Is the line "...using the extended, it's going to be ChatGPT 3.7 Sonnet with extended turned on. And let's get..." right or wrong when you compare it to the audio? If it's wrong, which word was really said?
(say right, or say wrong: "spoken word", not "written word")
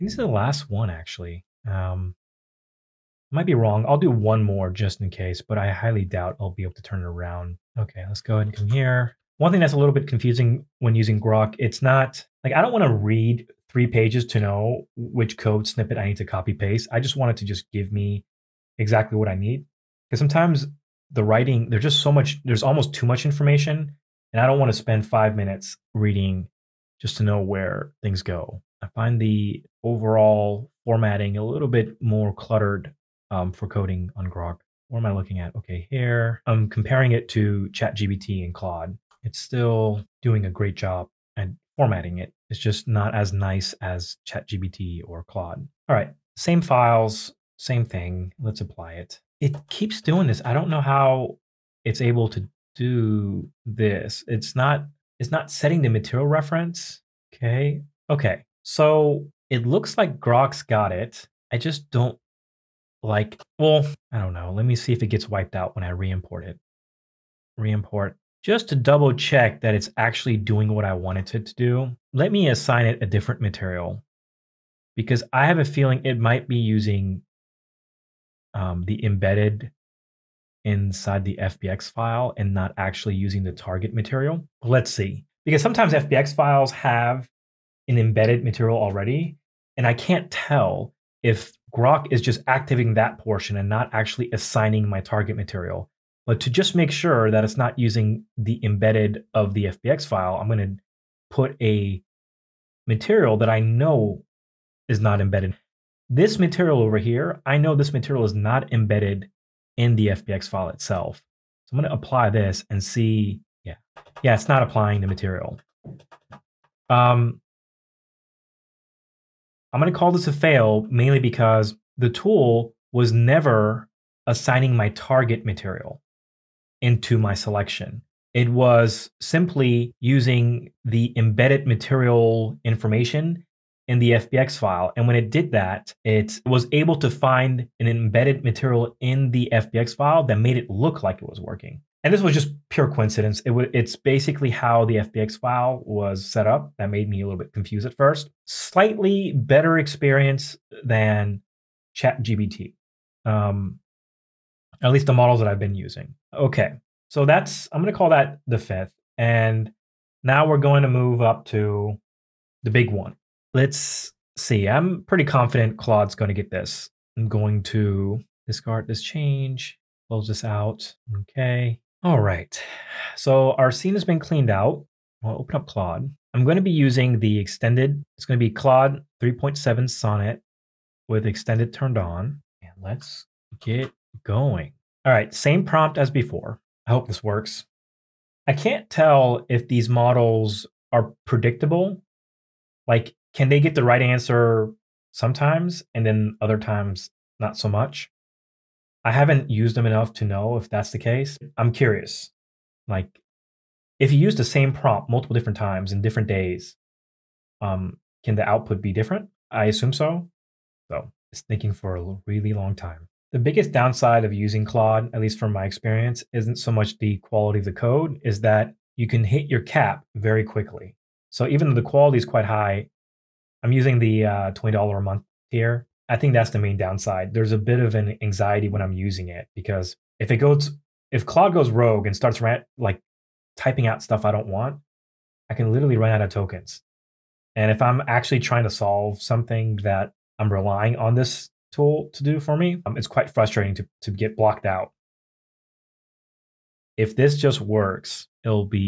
wrong: "Claude", not "ChatGPT".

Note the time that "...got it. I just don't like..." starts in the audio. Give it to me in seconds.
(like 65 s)
60 s.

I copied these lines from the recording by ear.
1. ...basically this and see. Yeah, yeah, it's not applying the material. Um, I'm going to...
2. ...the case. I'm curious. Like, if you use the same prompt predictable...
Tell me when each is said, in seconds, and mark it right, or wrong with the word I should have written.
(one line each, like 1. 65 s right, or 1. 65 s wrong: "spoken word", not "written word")
1. 111 s wrong: "apply", not "basically"
2. 200 s wrong: "multiple", not "predictable".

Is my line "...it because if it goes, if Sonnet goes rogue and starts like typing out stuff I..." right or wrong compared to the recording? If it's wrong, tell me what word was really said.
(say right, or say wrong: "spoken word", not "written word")
wrong: "Claude", not "Sonnet".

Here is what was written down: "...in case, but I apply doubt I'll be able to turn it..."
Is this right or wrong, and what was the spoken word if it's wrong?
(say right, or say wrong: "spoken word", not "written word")
wrong: "highly", not "apply".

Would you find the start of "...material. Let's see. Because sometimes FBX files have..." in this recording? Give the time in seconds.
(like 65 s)
83 s.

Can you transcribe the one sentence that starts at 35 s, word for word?
Okay, here I'm comparing it to ChatGPT and Claude.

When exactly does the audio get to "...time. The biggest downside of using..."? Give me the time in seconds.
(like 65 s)
212 s.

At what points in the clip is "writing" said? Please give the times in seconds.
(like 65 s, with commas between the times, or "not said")
21 s.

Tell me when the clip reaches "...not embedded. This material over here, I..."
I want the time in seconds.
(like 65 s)
104 s.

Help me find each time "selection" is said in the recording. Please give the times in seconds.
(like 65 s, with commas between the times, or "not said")
127 s.